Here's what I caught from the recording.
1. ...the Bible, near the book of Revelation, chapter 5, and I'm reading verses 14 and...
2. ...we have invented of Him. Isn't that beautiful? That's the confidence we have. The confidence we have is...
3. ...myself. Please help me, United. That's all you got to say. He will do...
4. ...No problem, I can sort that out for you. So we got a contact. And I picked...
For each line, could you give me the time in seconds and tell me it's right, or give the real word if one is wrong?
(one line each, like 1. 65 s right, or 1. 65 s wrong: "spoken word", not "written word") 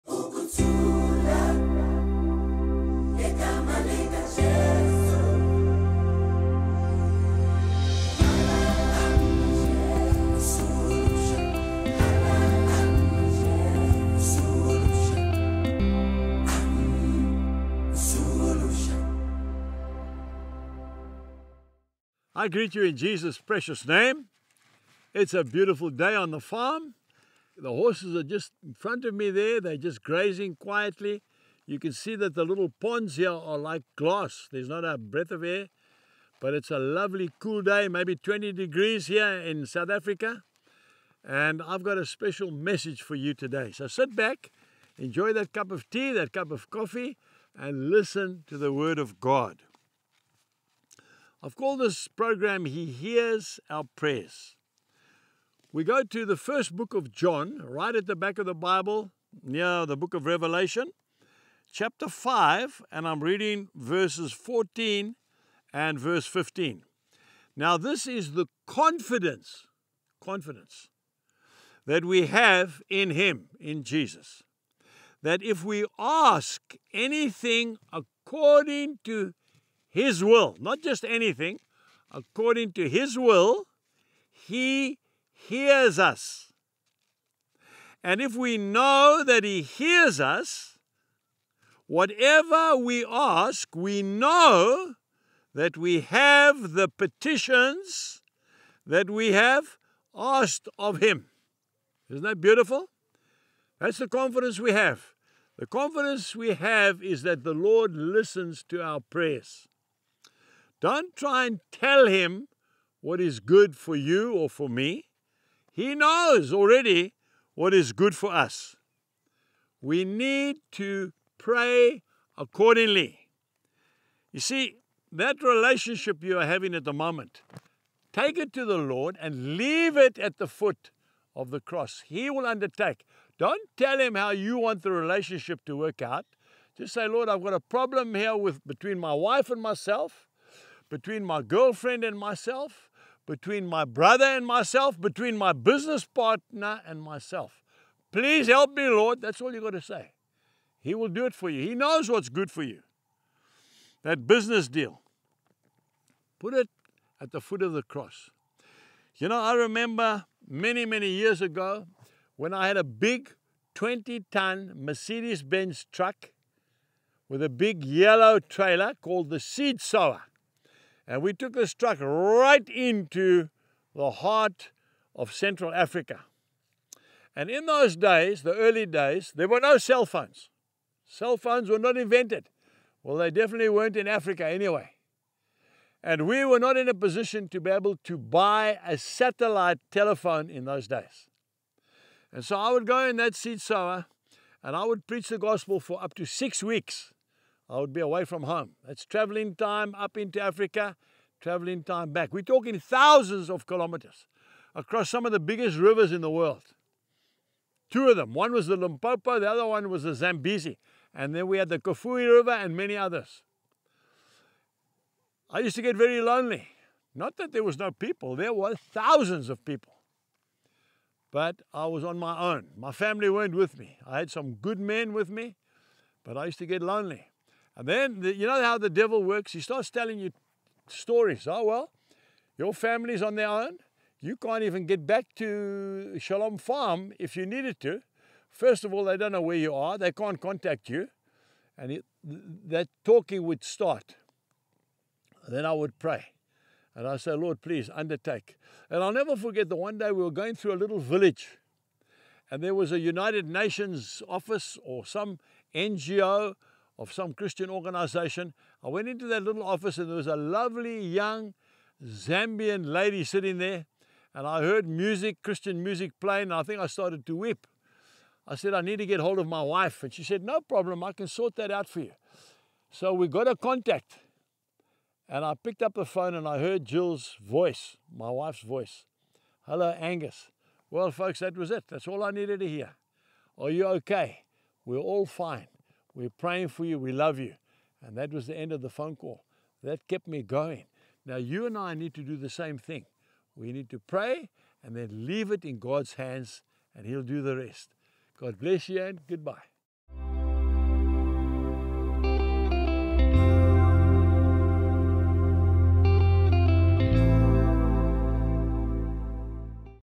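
1. 58 s right
2. 99 s wrong: "asked", not "invented"
3. 147 s wrong: "Lord", not "United"
4. 270 s right.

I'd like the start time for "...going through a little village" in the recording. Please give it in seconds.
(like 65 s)
250 s.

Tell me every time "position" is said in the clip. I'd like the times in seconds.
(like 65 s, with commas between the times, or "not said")
186 s.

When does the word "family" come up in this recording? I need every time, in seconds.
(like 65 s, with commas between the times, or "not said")
222 s, 232 s.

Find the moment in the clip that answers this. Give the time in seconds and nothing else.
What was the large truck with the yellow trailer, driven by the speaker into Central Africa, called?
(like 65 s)
169 s.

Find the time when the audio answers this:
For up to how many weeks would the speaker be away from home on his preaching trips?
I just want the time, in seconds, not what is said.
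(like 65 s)
196 s.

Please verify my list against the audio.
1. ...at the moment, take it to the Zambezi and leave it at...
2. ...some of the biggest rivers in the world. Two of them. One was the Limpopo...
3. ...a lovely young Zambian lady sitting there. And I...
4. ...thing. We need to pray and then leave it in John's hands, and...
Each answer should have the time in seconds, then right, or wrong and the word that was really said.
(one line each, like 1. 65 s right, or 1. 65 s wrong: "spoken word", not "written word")
1. 126 s wrong: "Lord", not "Zambezi"
2. 205 s right
3. 260 s right
4. 292 s wrong: "God", not "John".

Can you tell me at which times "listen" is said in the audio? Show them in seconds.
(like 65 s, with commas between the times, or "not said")
47 s, 107 s.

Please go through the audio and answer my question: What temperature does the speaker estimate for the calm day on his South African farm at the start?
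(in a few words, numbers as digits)
20 degrees.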